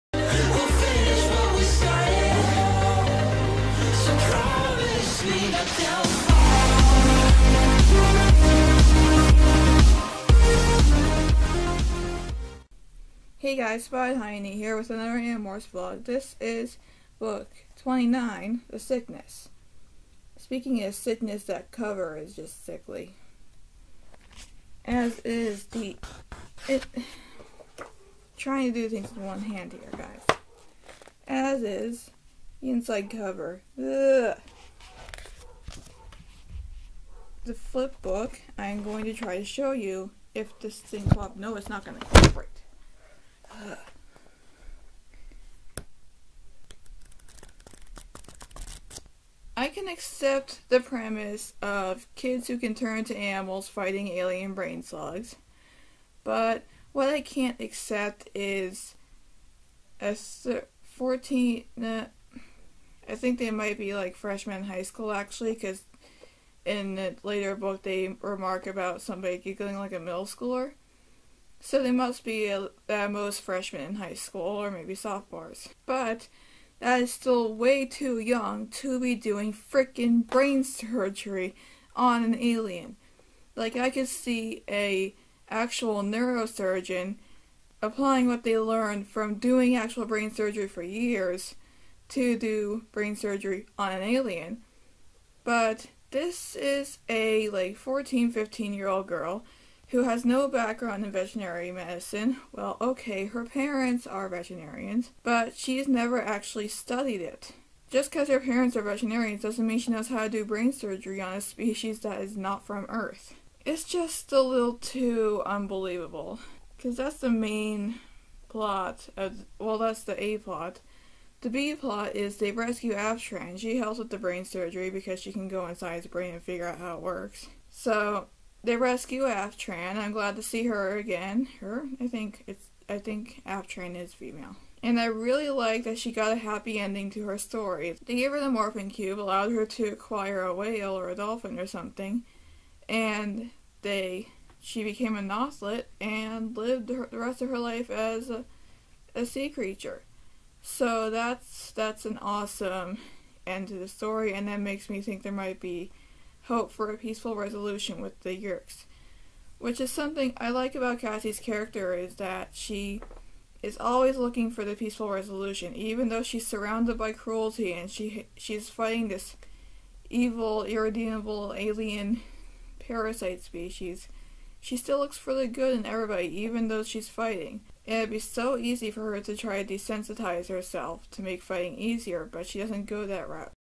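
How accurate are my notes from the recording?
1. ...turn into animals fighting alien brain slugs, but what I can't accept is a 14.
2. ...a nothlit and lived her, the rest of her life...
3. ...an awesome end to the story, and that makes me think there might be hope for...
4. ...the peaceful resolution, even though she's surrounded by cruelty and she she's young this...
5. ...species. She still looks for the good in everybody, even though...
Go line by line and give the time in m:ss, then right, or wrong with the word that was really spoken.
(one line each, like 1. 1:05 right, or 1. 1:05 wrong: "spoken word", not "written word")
1. 0:52 right
2. 2:25 right
3. 2:32 right
4. 2:44 wrong: "fighting", not "young"
5. 2:53 right.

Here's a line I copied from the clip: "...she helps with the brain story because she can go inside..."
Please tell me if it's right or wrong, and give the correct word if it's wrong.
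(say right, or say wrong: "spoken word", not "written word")
wrong: "surgery", not "story".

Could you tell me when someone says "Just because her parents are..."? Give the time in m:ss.
1:47.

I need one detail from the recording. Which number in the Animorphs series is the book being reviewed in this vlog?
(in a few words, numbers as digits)
29.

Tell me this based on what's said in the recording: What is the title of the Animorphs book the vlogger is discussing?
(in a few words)
The Sickness.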